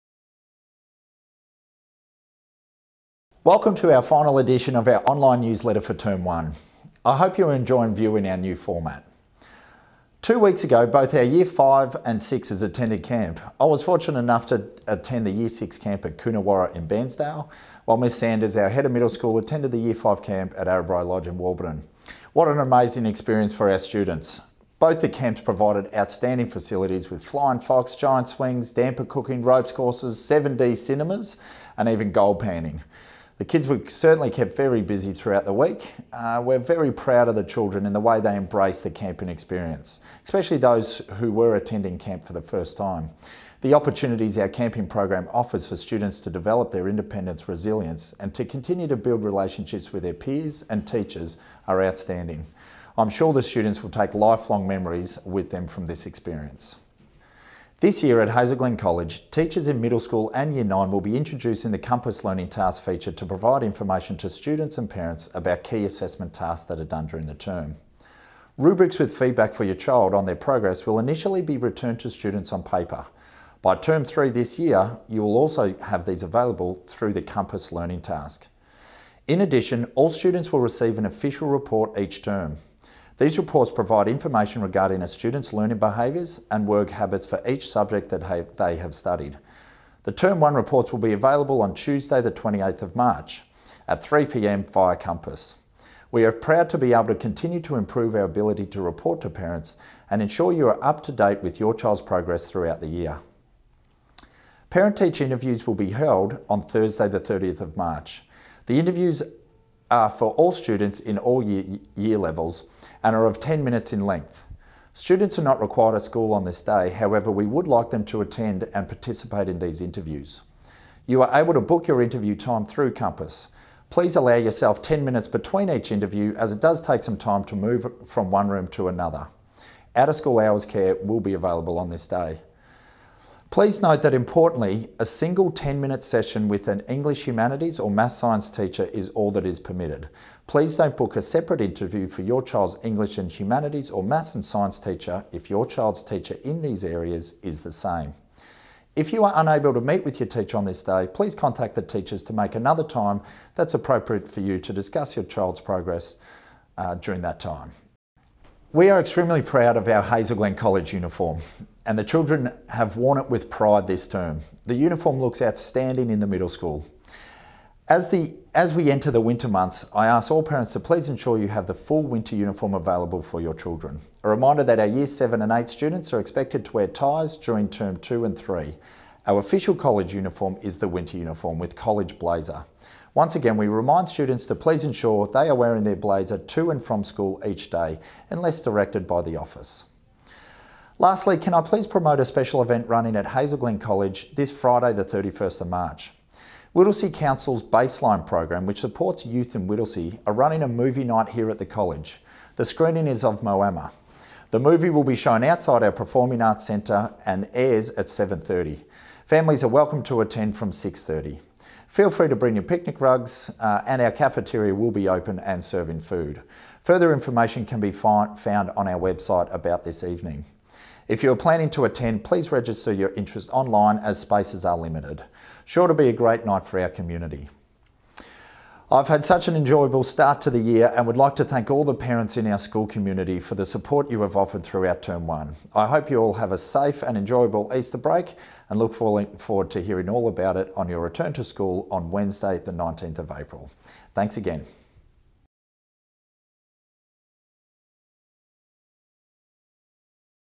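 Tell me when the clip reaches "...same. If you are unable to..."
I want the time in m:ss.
2:27.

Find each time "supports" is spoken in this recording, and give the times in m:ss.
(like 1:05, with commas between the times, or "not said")
3:18, 3:53.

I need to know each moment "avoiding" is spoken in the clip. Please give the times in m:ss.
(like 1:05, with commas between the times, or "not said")
not said.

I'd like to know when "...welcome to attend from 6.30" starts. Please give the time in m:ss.
3:29.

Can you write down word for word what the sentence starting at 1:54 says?
Students are not required at school on this day, however, we would like them to attend and participate in these interviews.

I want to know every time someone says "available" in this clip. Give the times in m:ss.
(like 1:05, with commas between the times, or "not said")
1:16, 1:31, 2:11, 2:52.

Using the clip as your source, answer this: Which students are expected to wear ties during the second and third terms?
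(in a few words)
Year 7 and 8.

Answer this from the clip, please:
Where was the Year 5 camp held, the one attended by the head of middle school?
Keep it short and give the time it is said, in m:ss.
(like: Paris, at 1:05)
Arrabri Lodge, at 0:20.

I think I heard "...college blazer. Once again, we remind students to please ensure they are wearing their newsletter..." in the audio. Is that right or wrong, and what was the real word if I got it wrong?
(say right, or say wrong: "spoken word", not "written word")
wrong: "blazer", not "newsletter".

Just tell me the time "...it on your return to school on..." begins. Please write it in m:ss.
4:00.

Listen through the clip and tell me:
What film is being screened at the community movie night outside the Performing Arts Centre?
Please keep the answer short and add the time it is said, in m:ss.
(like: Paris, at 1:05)
Moana, at 3:23.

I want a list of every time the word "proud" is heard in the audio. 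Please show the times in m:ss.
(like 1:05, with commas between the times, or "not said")
0:36, 1:36, 2:39.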